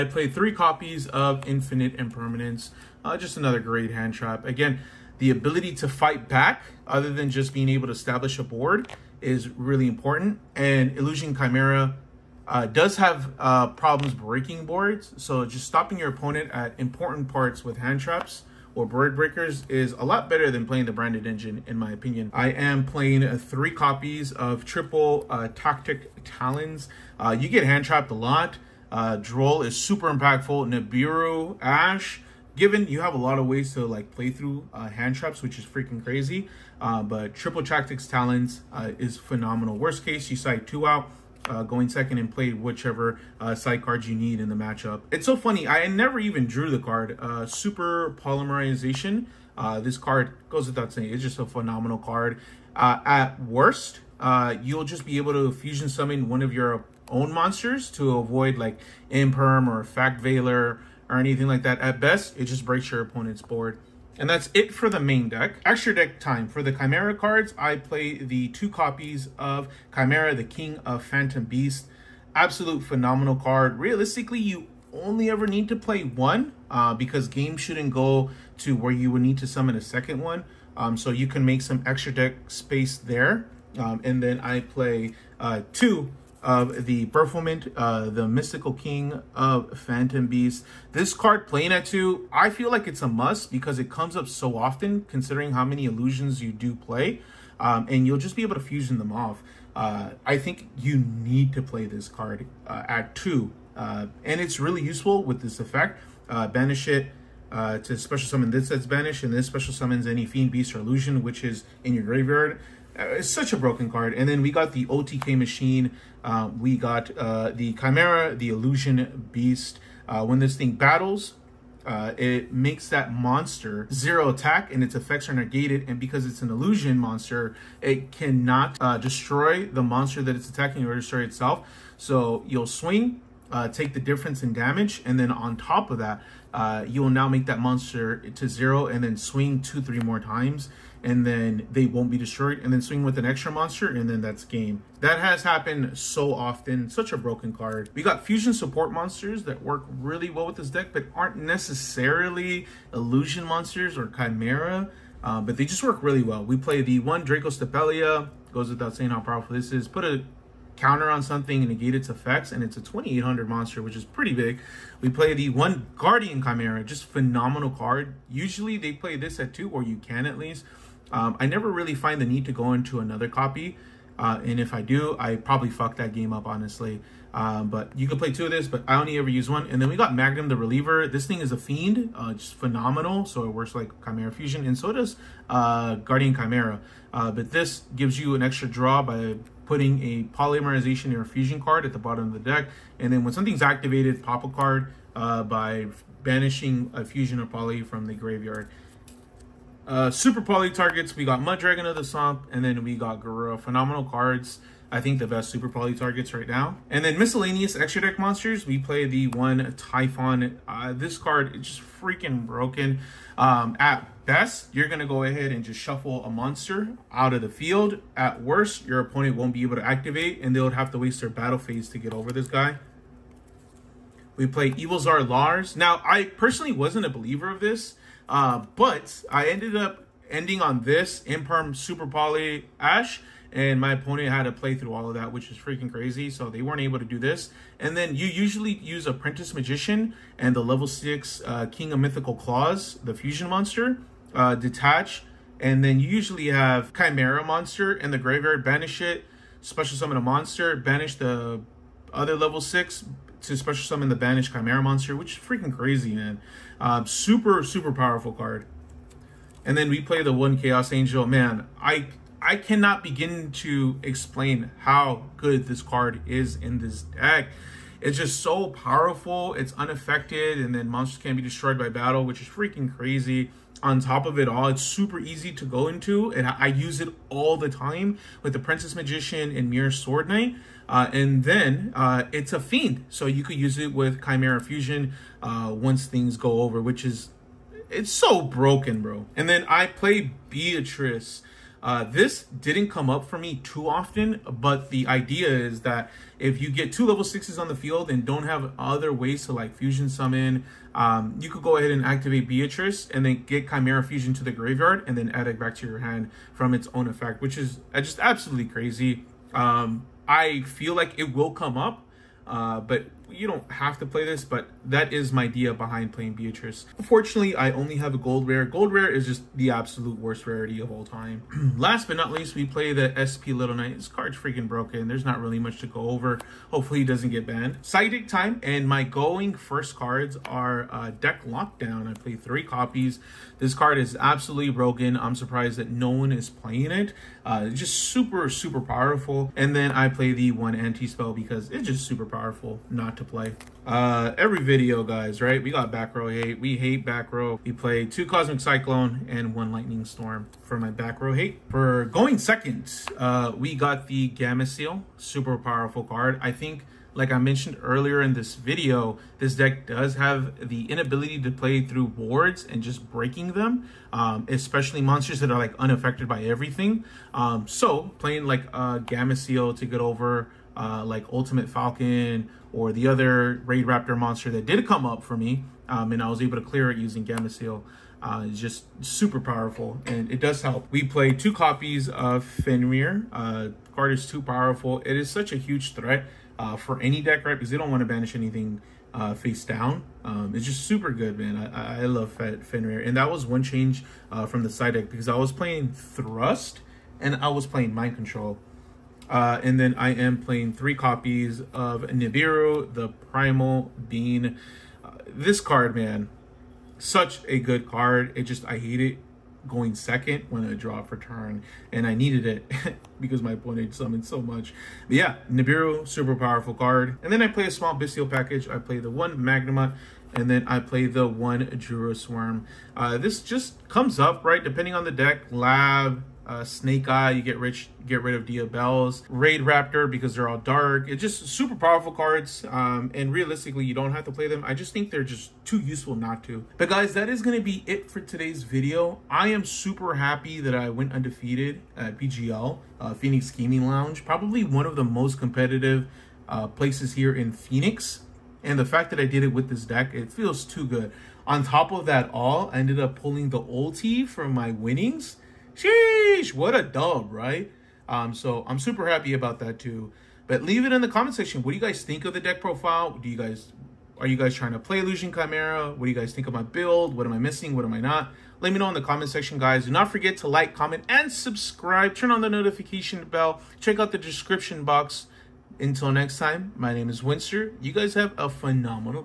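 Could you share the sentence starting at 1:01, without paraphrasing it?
At best, it just breaks your opponent's board.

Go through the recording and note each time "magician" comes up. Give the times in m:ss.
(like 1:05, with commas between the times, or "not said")
3:59, 4:38.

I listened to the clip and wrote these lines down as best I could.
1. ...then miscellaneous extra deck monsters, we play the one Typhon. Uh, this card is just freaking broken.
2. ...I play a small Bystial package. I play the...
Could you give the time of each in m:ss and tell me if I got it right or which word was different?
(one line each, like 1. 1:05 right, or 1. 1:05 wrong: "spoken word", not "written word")
1. 3:27 right
2. 6:57 right.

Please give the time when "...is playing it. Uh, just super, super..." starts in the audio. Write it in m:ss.
5:36.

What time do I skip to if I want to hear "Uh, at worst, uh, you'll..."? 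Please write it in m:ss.
0:52.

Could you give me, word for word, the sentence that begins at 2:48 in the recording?
Usually they play this at two, or you can at least.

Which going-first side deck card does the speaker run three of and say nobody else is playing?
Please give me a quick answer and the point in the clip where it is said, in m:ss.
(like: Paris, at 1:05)
Deck Lockdown, at 5:31.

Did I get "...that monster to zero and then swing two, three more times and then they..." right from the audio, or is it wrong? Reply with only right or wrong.
right.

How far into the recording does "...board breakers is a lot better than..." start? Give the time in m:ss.
0:18.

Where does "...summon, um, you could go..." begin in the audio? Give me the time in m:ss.
5:00.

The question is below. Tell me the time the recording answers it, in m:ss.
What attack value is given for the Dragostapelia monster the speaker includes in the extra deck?
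2:42.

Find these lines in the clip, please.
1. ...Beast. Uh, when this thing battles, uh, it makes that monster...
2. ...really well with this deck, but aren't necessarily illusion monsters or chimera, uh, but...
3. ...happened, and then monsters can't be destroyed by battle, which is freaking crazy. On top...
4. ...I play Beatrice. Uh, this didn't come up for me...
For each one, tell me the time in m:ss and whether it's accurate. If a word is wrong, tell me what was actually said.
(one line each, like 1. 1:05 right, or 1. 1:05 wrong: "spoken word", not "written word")
1. 1:59 right
2. 2:30 right
3. 4:29 wrong: "unaffected", not "happened"
4. 4:49 right.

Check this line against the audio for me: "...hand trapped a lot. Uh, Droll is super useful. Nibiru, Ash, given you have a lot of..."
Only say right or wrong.
wrong.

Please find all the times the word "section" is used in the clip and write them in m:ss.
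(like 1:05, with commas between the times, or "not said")
7:41, 7:49.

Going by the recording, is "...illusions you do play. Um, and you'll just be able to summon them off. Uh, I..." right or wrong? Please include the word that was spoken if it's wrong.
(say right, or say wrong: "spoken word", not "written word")
wrong: "fusion", not "summon".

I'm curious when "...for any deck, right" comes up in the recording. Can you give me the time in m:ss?
6:26.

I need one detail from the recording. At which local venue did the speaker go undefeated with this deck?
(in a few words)
Phoenix Gaming Lounge.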